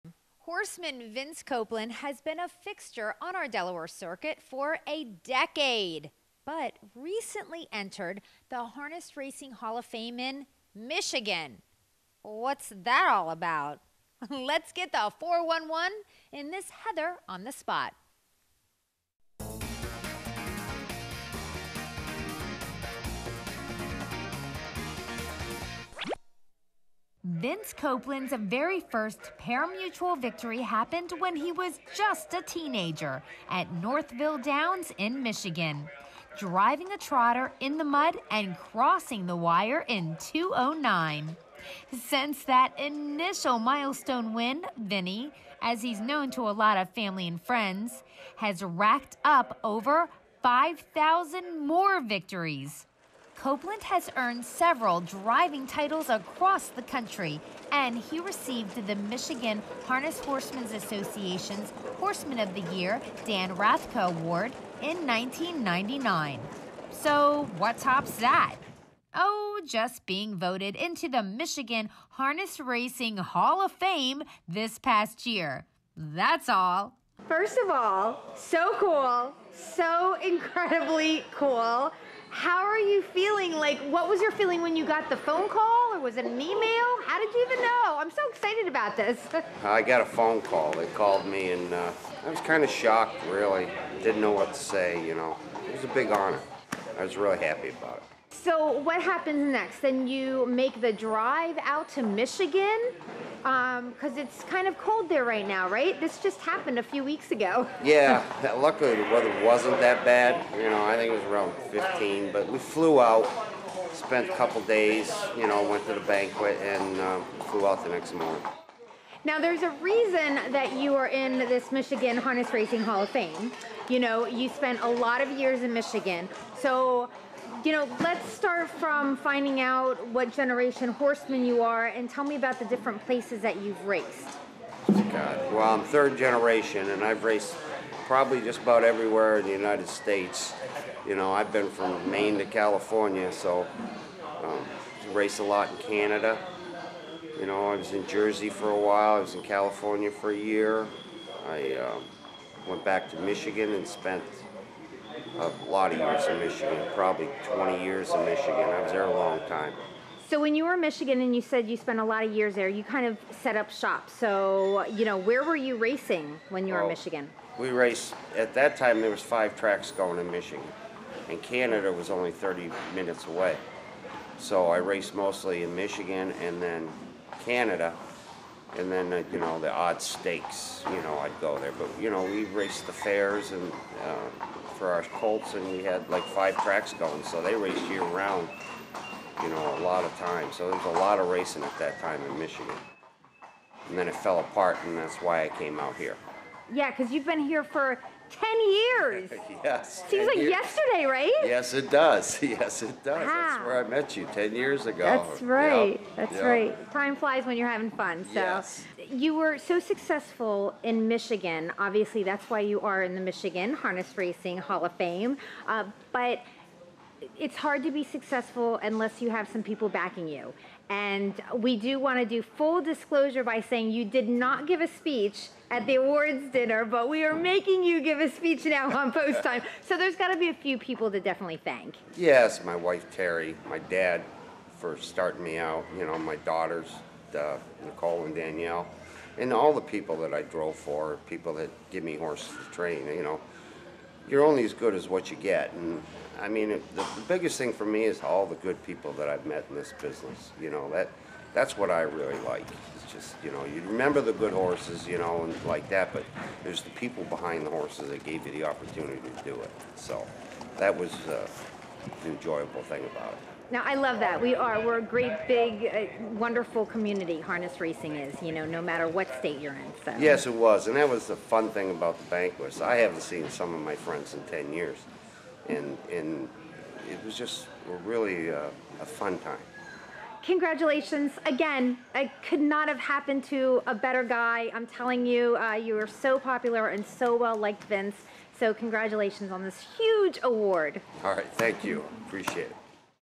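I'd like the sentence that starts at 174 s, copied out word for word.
So I raced mostly in Michigan and then Canada and then uh, you know the odd stakes.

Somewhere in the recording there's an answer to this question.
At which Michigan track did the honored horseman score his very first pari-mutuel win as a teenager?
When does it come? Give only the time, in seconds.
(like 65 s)
33 s.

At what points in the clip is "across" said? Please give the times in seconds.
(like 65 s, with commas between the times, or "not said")
56 s.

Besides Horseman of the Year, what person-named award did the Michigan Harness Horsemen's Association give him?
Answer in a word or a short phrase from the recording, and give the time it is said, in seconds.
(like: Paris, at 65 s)
Dan Rathka Award, at 63 s.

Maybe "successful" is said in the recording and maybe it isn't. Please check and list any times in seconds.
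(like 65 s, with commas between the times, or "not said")
209 s, 218 s.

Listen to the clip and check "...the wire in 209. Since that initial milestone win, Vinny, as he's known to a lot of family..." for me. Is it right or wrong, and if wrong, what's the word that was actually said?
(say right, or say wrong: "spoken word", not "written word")
right.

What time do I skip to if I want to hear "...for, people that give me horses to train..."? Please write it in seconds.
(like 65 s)
240 s.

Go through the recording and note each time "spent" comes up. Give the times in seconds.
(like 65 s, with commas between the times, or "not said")
113 s, 124 s, 153 s, 161 s.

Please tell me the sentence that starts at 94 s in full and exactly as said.
Didn't know what to say, you know.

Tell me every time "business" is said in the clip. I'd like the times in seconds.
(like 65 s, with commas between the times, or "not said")
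250 s.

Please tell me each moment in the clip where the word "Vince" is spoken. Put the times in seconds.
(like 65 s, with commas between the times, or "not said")
1 s, 27 s, 287 s.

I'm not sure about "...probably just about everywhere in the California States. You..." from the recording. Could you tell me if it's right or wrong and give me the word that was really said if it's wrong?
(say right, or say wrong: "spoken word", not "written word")
wrong: "United", not "California".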